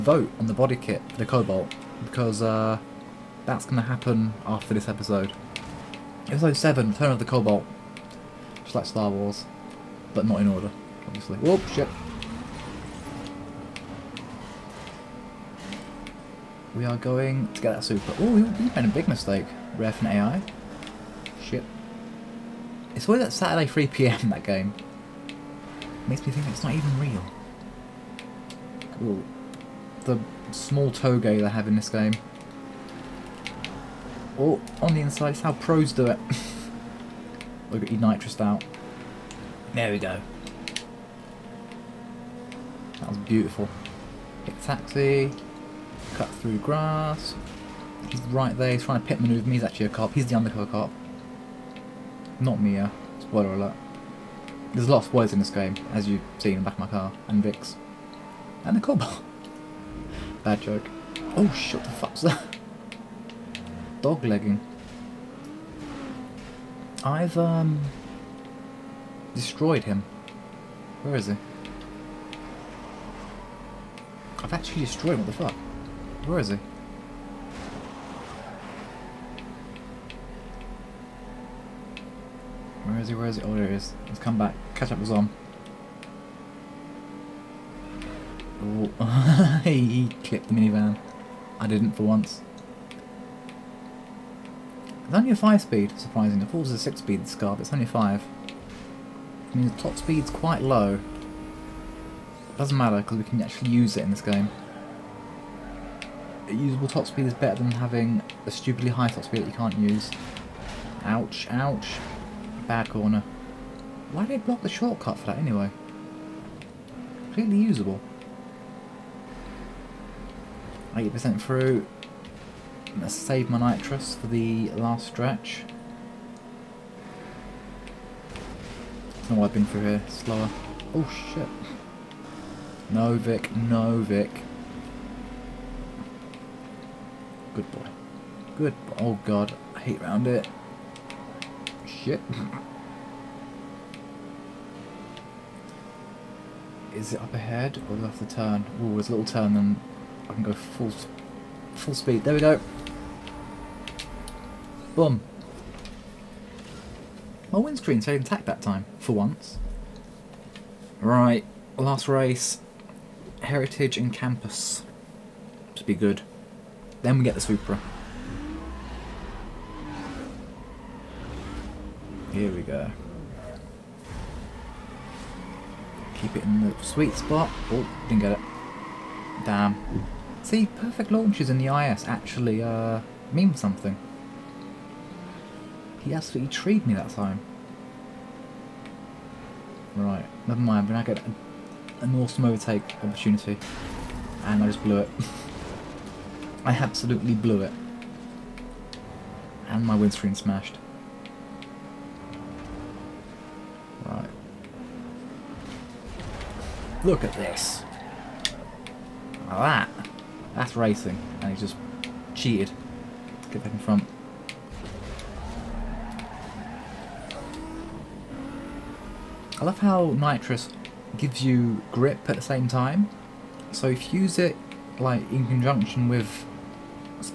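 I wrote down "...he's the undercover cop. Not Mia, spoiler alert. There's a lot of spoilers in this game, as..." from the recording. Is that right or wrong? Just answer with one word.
right.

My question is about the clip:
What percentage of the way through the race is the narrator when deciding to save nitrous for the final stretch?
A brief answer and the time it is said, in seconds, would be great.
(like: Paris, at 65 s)
80%, at 120 s.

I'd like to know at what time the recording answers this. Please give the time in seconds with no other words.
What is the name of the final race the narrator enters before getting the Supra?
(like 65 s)
163 s.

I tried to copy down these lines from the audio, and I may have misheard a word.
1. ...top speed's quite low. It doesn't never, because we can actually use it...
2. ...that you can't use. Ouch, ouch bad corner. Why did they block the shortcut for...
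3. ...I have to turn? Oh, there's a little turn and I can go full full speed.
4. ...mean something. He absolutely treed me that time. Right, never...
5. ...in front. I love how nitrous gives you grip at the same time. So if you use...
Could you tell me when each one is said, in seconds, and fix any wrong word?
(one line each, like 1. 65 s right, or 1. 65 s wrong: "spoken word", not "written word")
1. 99 s wrong: "matter", not "never"
2. 109 s right
3. 148 s right
4. 183 s right
5. 213 s right.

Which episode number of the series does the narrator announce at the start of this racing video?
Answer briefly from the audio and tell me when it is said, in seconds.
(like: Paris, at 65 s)
7, at 6 s.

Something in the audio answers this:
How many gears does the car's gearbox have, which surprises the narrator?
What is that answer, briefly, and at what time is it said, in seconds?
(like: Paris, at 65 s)
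5, at 95 s.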